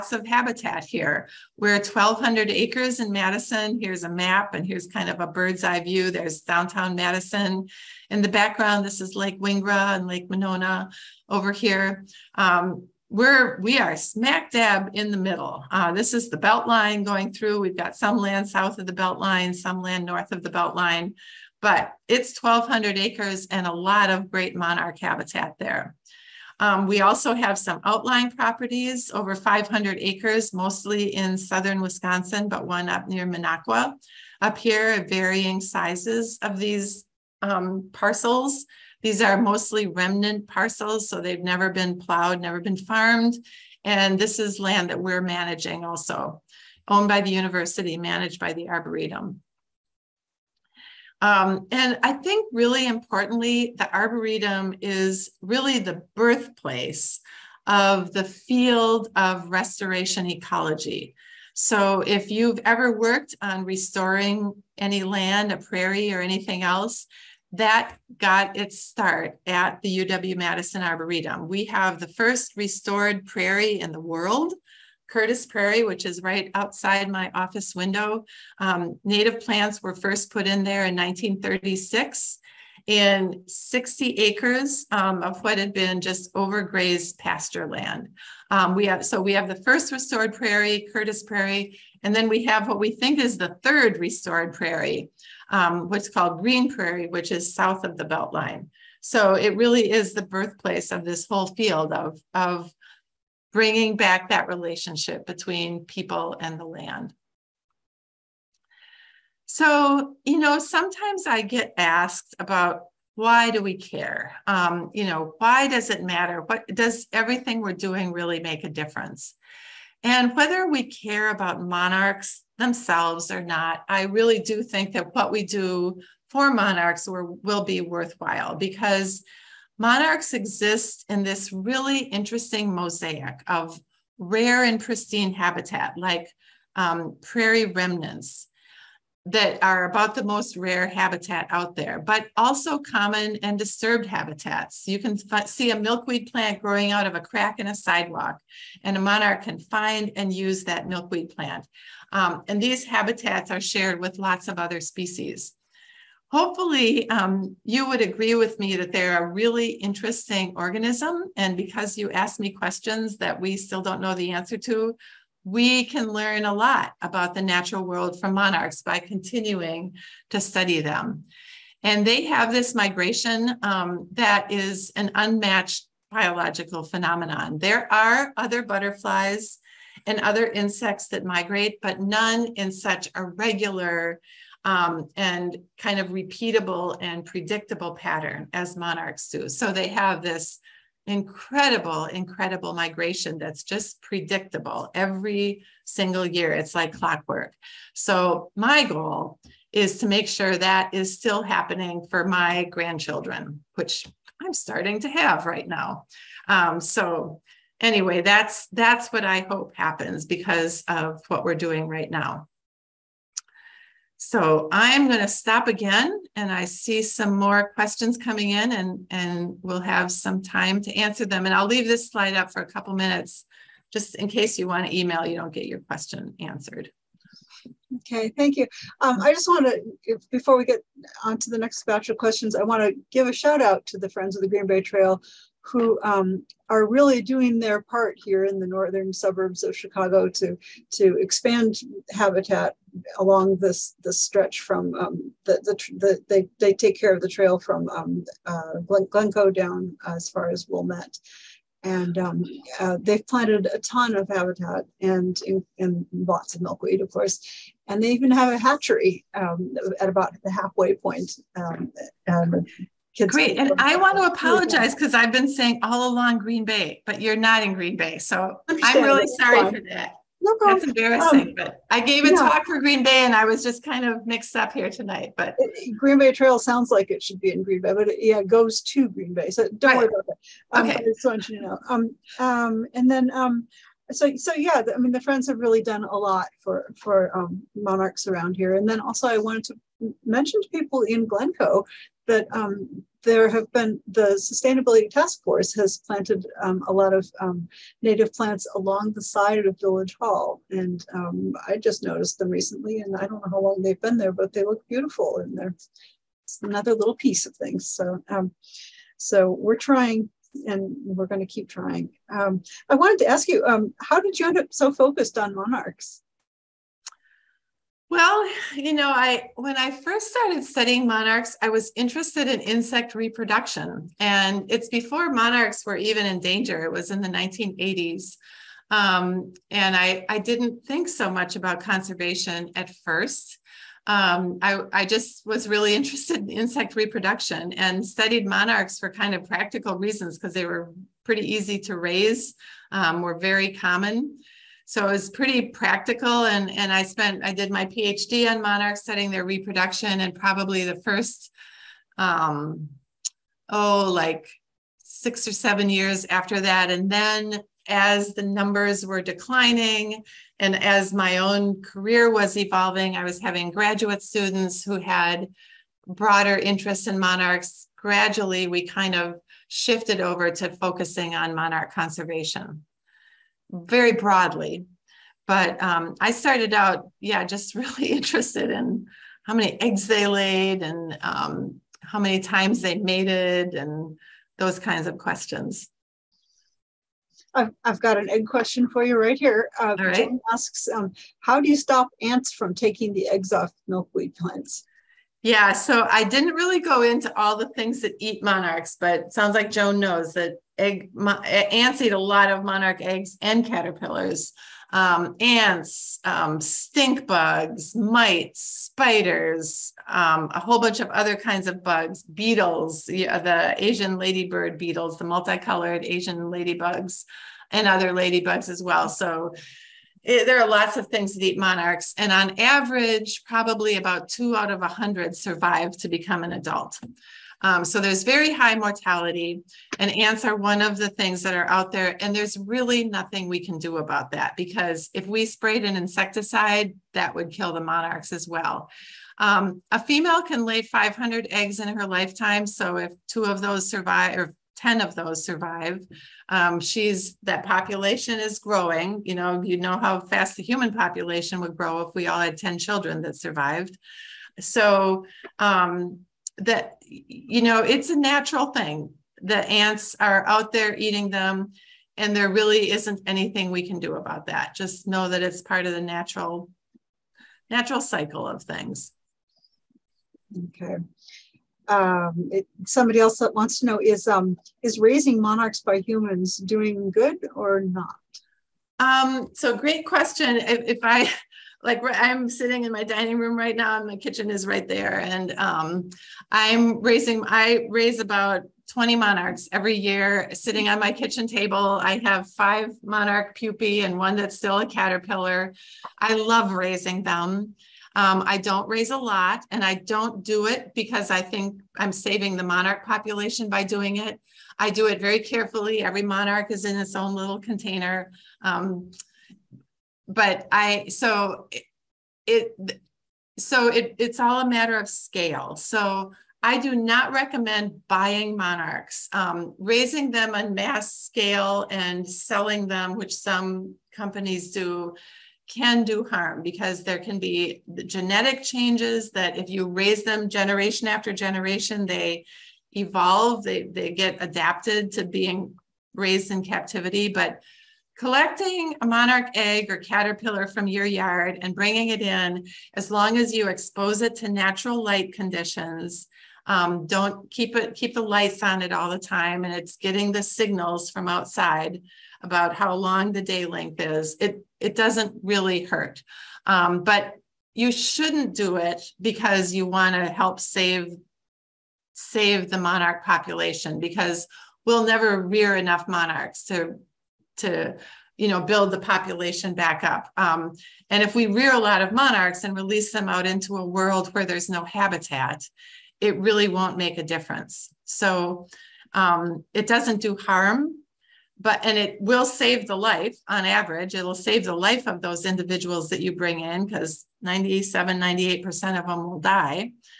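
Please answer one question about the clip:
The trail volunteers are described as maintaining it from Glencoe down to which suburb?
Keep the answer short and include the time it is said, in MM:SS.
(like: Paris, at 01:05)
Wilmette, at 04:10.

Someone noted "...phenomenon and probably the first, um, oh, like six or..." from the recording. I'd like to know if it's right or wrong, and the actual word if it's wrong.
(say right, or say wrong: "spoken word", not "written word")
wrong: "reproduction", not "phenomenon".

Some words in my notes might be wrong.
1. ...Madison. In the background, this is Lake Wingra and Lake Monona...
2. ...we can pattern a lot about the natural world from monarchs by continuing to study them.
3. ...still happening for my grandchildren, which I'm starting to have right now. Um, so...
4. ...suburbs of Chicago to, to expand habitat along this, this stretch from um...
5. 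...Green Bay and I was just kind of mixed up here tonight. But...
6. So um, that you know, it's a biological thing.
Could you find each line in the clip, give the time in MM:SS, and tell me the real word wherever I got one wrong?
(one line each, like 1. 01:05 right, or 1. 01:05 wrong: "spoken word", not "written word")
1. 00:06 right
2. 02:45 wrong: "learn", not "pattern"
3. 03:21 right
4. 03:59 right
5. 04:32 right
6. 07:34 wrong: "natural", not "biological".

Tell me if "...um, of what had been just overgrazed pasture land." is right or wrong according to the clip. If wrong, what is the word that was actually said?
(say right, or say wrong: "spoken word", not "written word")
right.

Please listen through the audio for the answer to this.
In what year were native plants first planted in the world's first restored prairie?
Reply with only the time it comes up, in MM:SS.
01:20.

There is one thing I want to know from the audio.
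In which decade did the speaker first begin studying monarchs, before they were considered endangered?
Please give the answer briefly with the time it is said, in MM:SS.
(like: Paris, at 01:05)
1980s, at 05:27.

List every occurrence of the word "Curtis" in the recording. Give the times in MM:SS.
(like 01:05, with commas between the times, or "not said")
01:15, 01:30.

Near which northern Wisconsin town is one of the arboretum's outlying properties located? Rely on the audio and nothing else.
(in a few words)
Minocqua.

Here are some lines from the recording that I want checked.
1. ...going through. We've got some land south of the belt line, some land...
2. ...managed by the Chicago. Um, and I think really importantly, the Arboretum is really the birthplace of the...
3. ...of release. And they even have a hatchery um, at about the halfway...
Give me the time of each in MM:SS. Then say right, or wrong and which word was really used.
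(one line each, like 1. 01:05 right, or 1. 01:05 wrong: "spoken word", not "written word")
1. 00:17 right
2. 00:47 wrong: "Arboretum", not "Chicago"
3. 04:17 wrong: "course", not "release".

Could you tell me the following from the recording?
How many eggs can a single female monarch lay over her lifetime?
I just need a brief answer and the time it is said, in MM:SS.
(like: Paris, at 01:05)
500, at 07:20.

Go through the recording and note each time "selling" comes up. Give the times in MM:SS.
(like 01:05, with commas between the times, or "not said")
08:42.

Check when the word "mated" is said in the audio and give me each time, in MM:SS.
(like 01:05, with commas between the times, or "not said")
06:22.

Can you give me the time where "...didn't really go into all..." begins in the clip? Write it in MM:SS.
06:36.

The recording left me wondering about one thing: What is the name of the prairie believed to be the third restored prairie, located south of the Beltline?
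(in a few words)
Green Prairie.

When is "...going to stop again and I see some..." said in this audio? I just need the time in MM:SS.
03:35.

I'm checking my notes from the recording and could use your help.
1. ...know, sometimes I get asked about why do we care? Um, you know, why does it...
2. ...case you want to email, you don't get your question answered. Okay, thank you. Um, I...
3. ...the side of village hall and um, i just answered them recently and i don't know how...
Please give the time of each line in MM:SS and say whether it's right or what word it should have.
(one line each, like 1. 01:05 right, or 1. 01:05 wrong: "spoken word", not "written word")
1. 01:50 right
2. 03:44 right
3. 04:59 wrong: "noticed", not "answered".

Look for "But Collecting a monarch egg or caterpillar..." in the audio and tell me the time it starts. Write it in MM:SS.
08:57.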